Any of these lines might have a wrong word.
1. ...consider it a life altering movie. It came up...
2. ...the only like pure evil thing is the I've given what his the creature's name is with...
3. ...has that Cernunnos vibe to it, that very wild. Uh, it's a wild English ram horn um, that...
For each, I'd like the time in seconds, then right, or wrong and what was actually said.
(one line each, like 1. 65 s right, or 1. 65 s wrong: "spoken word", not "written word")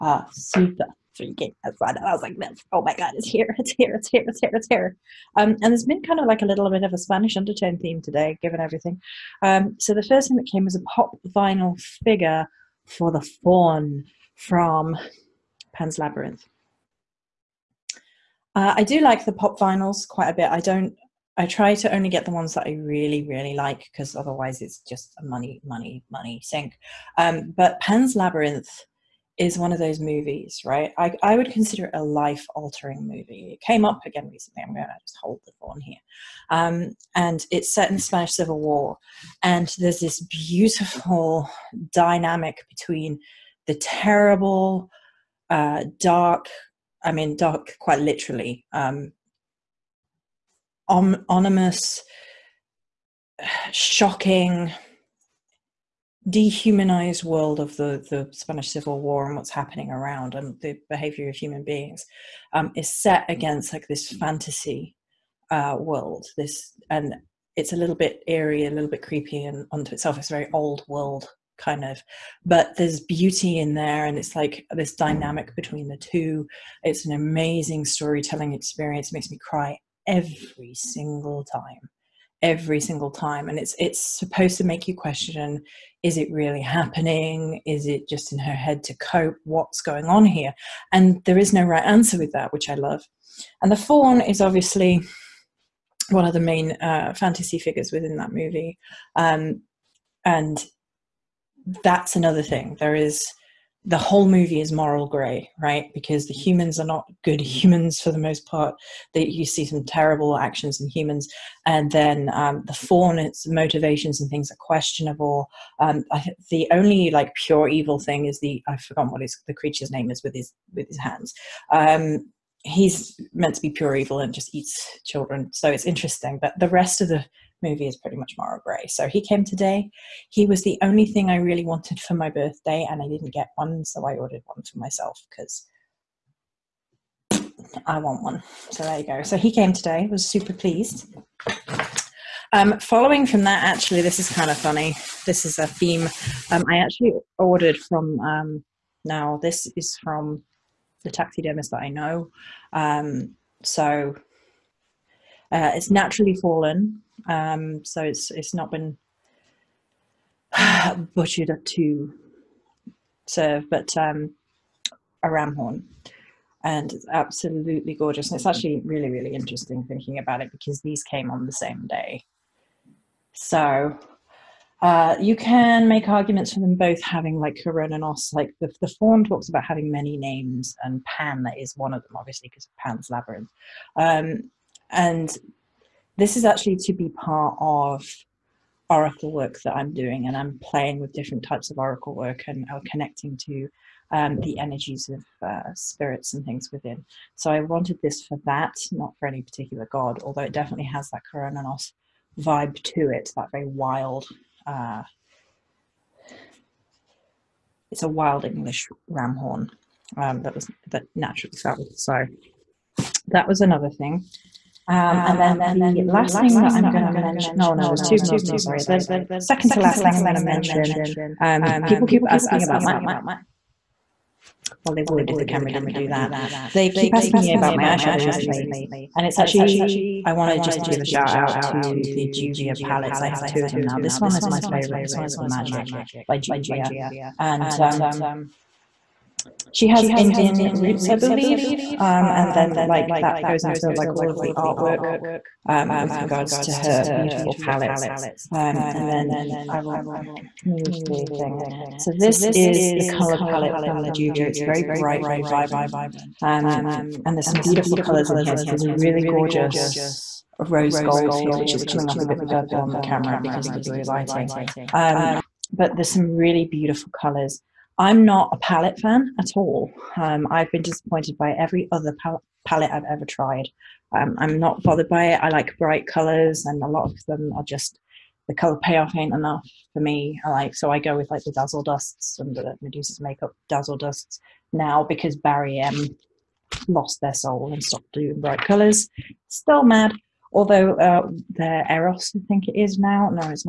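1. 31 s right
2. 116 s wrong: "forgotten", not "given"
3. 200 s right.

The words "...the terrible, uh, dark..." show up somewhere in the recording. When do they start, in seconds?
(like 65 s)
43 s.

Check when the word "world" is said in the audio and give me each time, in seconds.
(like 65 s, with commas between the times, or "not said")
57 s, 65 s, 70 s.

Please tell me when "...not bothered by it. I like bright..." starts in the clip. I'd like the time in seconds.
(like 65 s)
274 s.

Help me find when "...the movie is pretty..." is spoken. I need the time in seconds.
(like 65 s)
127 s.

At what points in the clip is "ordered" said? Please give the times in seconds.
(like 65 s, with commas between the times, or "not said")
134 s, 147 s.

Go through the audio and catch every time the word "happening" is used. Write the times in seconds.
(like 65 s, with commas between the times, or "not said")
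59 s, 86 s.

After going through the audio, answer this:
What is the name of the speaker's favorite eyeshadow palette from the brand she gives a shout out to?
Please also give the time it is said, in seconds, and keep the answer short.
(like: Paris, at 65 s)
Magic by Juvia, at 235 s.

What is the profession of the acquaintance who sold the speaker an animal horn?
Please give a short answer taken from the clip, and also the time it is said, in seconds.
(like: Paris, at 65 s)
Taxidermist, at 151 s.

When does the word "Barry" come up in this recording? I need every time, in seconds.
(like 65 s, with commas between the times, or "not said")
285 s.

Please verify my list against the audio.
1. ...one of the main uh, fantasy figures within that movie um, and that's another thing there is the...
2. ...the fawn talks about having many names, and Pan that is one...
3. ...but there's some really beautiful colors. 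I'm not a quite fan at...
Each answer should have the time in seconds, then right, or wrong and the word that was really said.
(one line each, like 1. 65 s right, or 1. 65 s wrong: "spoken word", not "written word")
1. 96 s right
2. 178 s right
3. 265 s wrong: "palette", not "quite".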